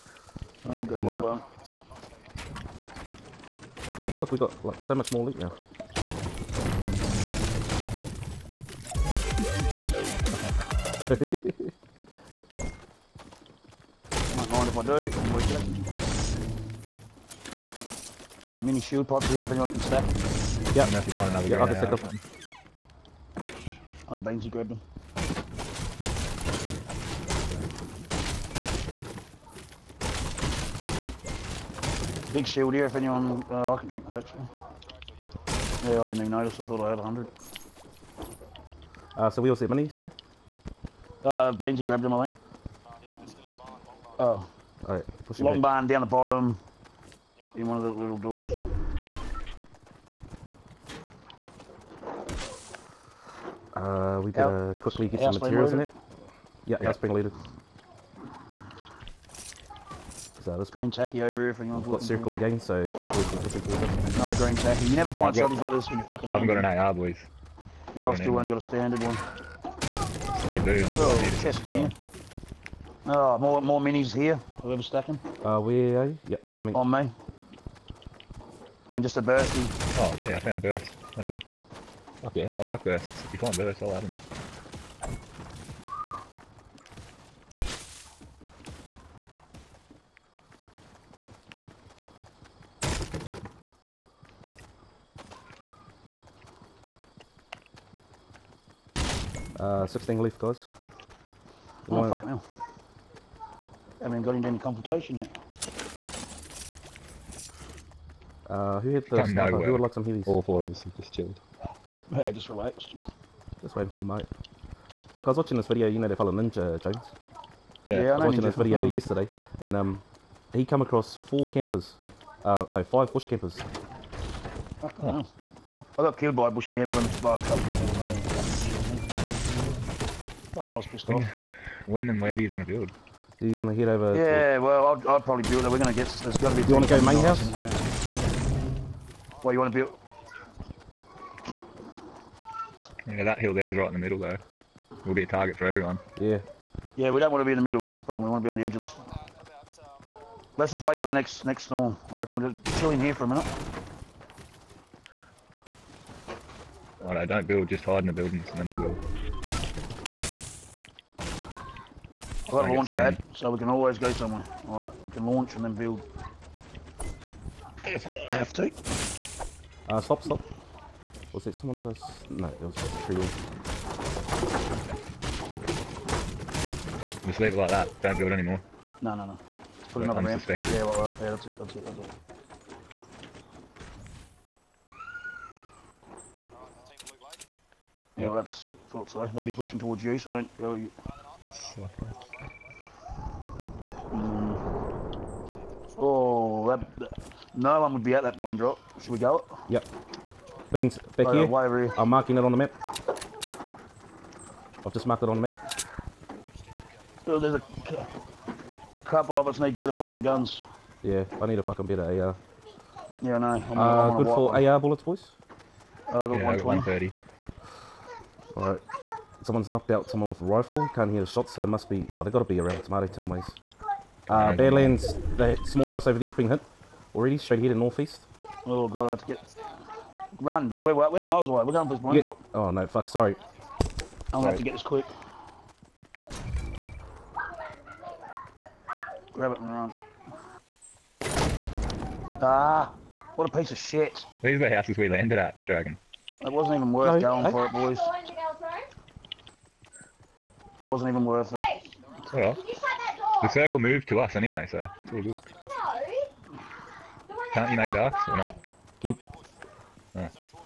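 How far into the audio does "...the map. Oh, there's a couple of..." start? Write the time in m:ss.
3:25.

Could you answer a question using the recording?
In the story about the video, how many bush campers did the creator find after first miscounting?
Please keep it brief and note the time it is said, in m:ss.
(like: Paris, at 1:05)
5, at 2:02.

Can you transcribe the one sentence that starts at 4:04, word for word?
These are the houses we landed at, Dragon.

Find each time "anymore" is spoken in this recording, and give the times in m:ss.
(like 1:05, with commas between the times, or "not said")
2:58.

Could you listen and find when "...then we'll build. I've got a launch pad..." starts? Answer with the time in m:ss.
2:38.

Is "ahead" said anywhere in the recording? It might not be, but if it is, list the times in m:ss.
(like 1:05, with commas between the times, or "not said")
3:47.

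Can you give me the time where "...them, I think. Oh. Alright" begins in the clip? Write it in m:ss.
0:42.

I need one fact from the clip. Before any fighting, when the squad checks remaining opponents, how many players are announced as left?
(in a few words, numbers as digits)
16.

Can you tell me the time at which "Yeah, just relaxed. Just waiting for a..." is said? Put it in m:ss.
1:52.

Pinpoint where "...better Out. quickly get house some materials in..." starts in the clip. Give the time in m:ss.
0:54.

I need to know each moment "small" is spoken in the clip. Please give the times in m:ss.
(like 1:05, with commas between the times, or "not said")
3:45.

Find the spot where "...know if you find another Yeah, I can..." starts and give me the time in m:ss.
0:20.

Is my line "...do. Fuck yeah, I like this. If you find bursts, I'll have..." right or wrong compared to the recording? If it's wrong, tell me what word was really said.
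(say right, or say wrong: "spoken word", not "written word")
right.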